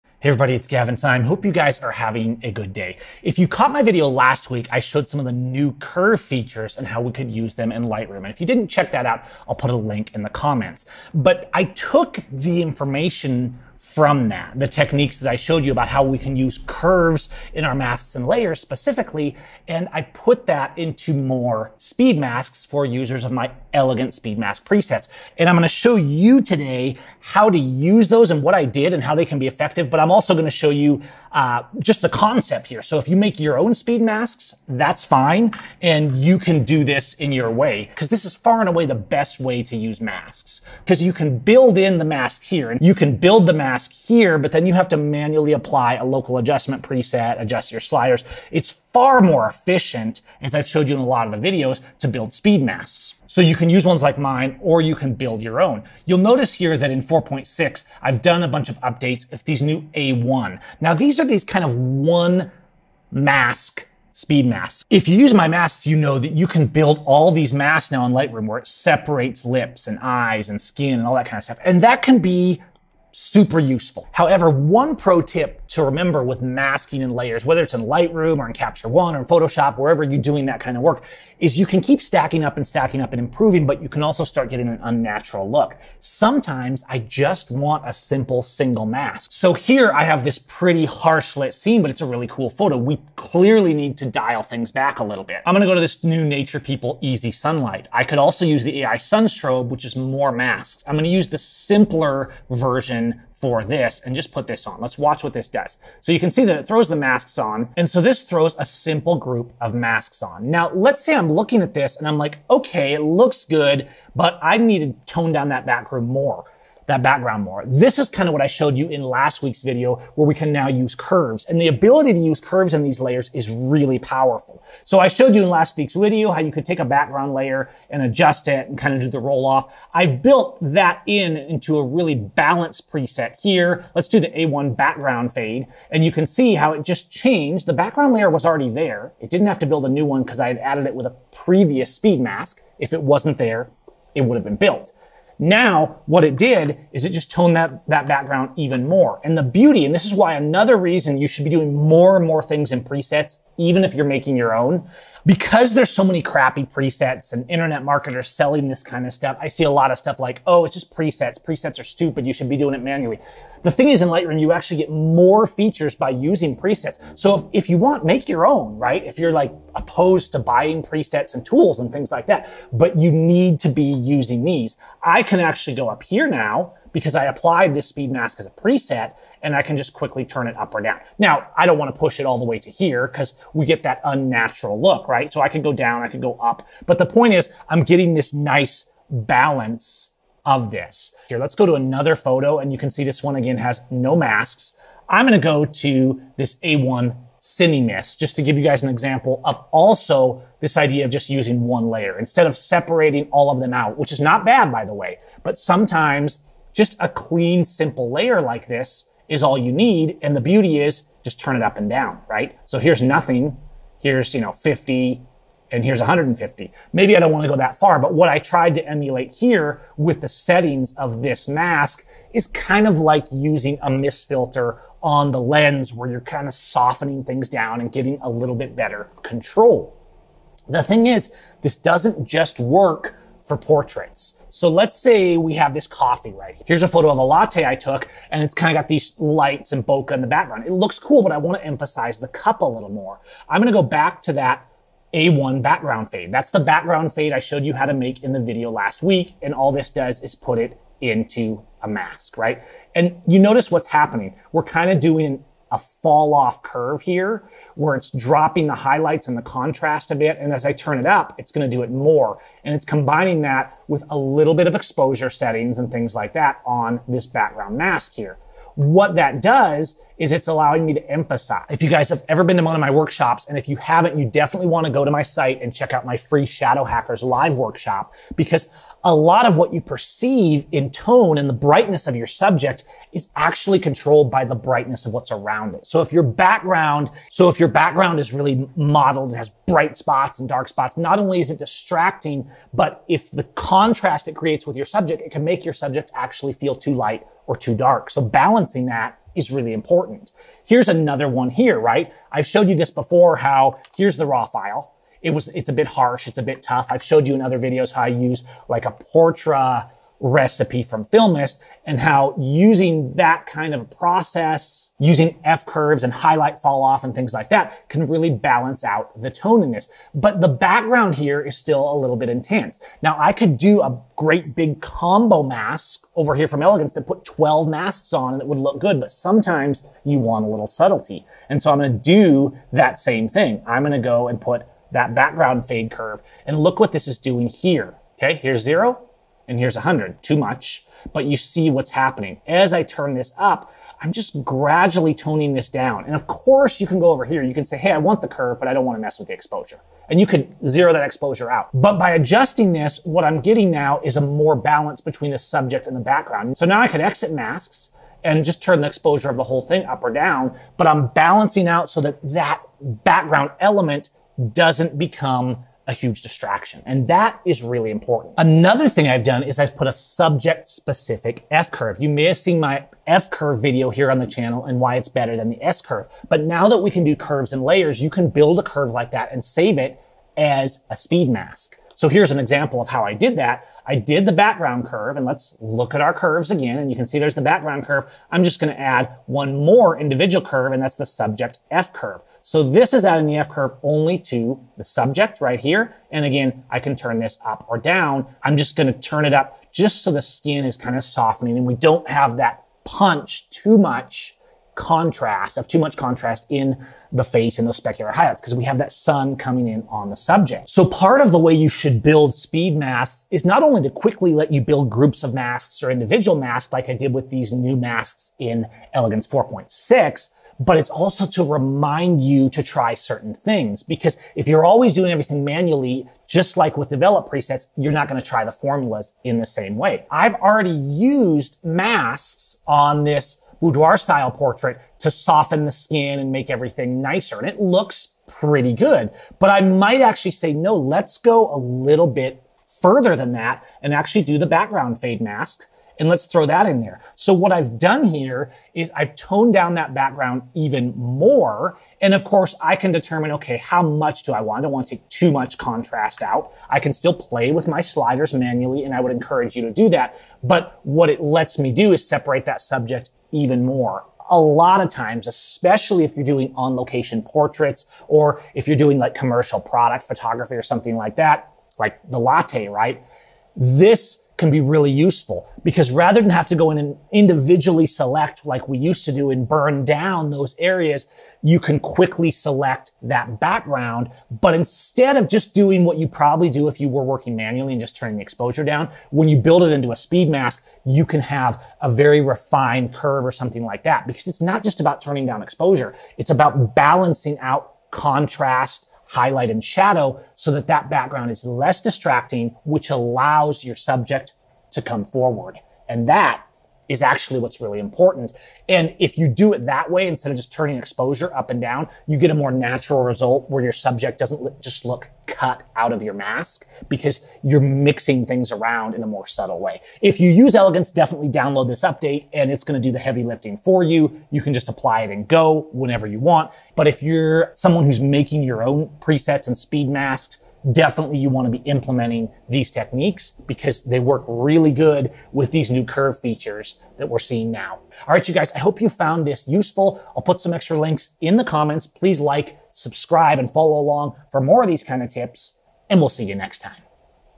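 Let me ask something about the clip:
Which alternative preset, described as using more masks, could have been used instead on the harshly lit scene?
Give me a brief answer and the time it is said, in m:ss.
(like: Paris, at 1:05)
AI Sun Strobe, at 1:38.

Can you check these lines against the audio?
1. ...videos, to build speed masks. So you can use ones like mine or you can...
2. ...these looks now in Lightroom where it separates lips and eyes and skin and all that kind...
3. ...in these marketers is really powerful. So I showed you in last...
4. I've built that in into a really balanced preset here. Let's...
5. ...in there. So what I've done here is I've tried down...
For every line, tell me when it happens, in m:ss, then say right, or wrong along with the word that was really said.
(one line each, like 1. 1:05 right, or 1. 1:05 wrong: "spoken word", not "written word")
1. 0:51 right
2. 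1:07 wrong: "masks", not "looks"
3. 2:02 wrong: "layers", not "marketers"
4. 2:09 right
5. 7:26 wrong: "toned", not "tried".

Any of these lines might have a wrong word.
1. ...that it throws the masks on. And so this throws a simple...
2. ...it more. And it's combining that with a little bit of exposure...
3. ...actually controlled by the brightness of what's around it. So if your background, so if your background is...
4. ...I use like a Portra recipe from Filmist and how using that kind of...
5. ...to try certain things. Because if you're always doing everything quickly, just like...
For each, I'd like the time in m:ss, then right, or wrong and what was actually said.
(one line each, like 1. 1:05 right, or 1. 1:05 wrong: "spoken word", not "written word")
1. 1:46 right
2. 4:21 right
3. 4:43 right
4. 5:08 right
5. 7:02 wrong: "manually", not "quickly".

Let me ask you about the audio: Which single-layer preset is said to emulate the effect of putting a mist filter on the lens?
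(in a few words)
A1 Cinemist.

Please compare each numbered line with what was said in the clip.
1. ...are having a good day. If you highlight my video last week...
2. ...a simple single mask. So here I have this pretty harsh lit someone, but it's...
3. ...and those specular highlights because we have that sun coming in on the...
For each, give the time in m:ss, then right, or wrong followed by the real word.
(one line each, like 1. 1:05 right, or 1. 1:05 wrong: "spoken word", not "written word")
1. 0:01 wrong: "caught", not "highlight"
2. 1:27 wrong: "scene", not "someone"
3. 6:47 right.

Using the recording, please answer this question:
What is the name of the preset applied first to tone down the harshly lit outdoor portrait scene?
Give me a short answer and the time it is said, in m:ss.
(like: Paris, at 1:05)
Nature People Easy Sunlight, at 1:36.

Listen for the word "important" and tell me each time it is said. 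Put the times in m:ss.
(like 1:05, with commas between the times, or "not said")
4:59, 6:07, 8:27.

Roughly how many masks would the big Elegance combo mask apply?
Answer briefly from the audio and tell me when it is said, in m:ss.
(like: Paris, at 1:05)
12, at 5:27.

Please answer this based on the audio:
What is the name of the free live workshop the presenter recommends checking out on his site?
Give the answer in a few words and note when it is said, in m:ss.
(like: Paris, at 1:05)
Shadow Hunters, at 4:36.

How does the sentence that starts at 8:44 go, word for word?
You can just apply it and go whenever you want.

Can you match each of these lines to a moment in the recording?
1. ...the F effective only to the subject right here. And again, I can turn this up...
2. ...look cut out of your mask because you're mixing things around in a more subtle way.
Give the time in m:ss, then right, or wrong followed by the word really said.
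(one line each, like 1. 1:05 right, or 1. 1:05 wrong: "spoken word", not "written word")
1. 6:33 wrong: "curve", not "effective"
2. 8:34 right.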